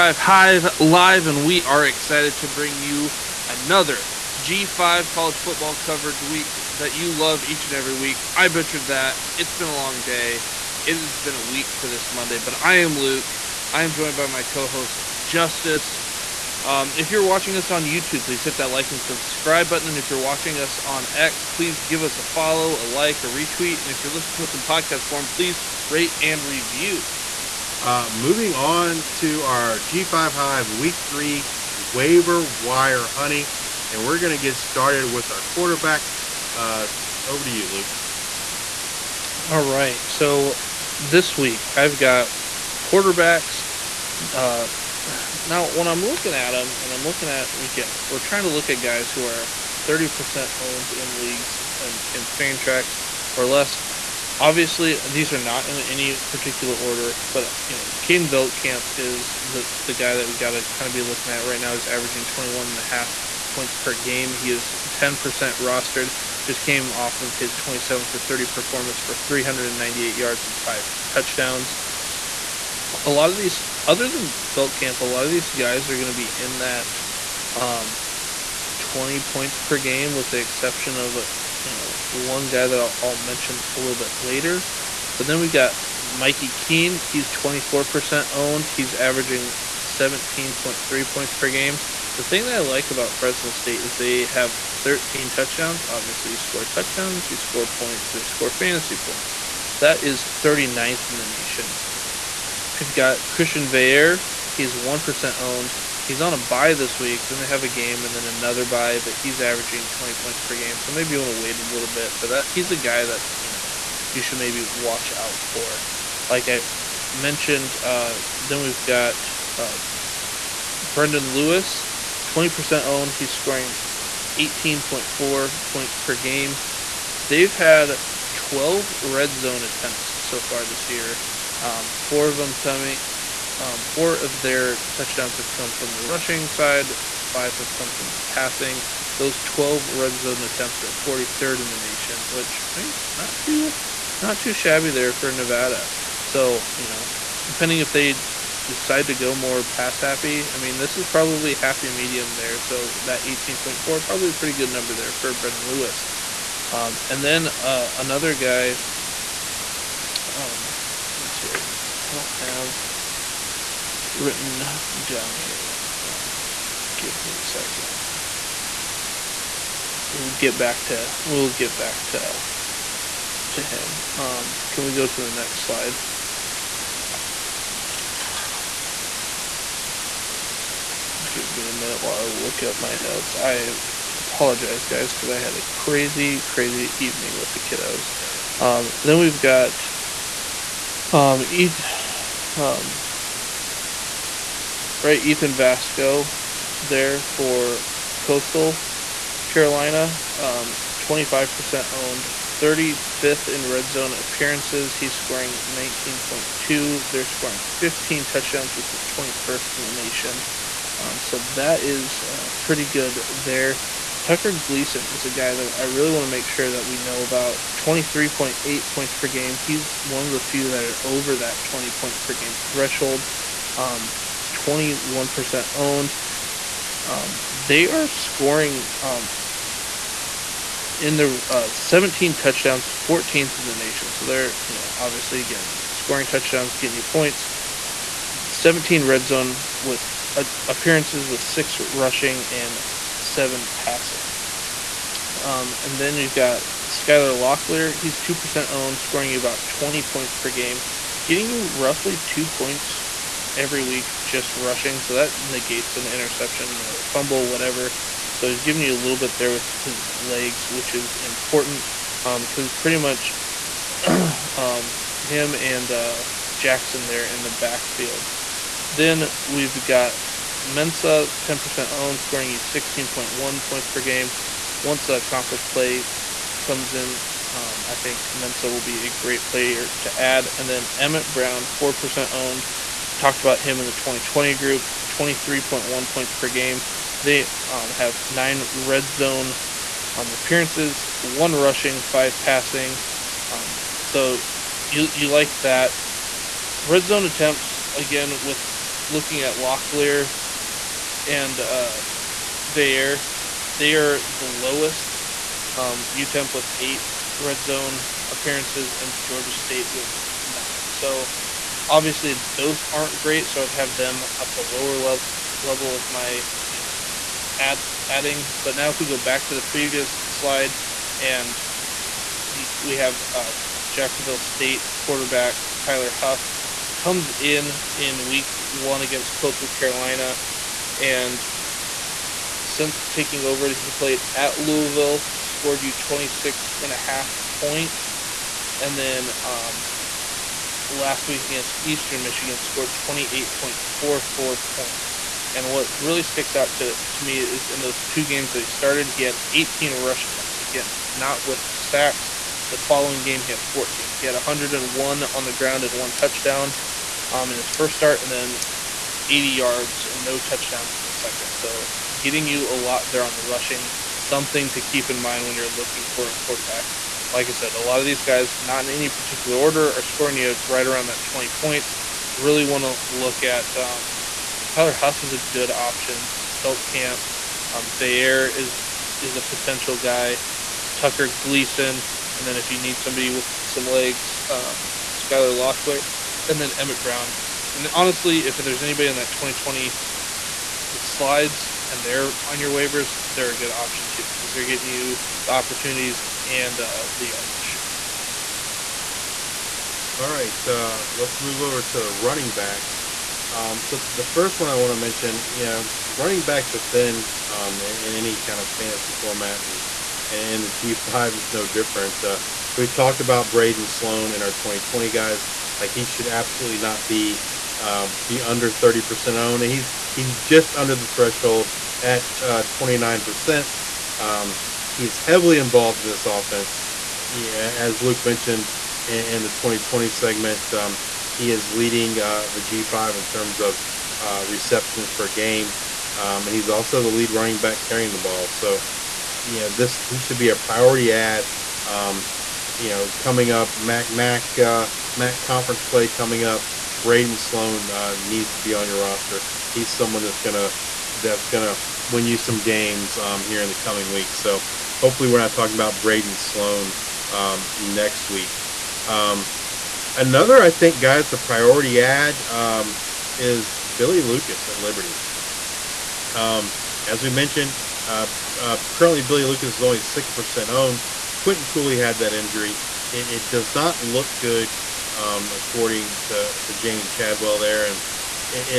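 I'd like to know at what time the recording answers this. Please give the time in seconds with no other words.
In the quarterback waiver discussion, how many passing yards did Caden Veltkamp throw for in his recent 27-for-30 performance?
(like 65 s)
69 s.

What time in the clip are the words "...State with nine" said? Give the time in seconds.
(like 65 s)
309 s.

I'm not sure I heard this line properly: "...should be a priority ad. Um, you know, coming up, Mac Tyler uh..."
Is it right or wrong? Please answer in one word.
wrong.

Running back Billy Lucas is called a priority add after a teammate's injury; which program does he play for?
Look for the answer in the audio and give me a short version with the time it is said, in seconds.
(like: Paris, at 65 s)
Liberty, at 464 s.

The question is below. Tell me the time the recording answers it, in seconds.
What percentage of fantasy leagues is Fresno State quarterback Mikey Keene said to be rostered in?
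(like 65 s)
87 s.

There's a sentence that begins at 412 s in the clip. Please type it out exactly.
Uh, so we talked about Braedon Sloan and our 2020 guys.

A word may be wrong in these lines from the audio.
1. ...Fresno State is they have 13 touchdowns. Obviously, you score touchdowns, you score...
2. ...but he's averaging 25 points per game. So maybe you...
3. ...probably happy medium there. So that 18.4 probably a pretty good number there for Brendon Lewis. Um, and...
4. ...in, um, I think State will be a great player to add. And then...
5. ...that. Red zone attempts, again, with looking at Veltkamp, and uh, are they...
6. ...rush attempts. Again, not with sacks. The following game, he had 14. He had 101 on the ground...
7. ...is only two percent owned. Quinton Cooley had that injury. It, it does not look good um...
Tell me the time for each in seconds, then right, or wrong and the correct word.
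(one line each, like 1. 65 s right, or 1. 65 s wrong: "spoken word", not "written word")
1. 93 s right
2. 109 s wrong: "20", not "25"
3. 151 s right
4. 276 s wrong: "Mensa", not "State"
5. 295 s wrong: "Locklear", not "Veltkamp"
6. 349 s right
7. 469 s wrong: "six", not "two".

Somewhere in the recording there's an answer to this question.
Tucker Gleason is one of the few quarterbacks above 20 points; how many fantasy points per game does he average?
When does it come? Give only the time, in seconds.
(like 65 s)
217 s.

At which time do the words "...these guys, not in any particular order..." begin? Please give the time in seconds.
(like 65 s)
368 s.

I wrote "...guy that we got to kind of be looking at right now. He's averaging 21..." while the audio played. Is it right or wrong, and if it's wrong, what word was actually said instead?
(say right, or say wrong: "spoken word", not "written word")
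right.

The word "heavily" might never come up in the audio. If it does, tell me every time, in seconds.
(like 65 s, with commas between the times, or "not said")
425 s.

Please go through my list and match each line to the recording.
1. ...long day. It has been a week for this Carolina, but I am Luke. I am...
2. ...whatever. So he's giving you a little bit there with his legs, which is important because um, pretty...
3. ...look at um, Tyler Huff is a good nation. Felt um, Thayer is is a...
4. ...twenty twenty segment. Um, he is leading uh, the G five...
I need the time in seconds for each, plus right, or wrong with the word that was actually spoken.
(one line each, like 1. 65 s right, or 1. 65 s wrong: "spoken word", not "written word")
1. 9 s wrong: "Monday", not "Carolina"
2. 257 s right
3. 373 s wrong: "option", not "nation"
4. 429 s right.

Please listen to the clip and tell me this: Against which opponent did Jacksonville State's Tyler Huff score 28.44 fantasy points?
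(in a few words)
Eastern Michigan.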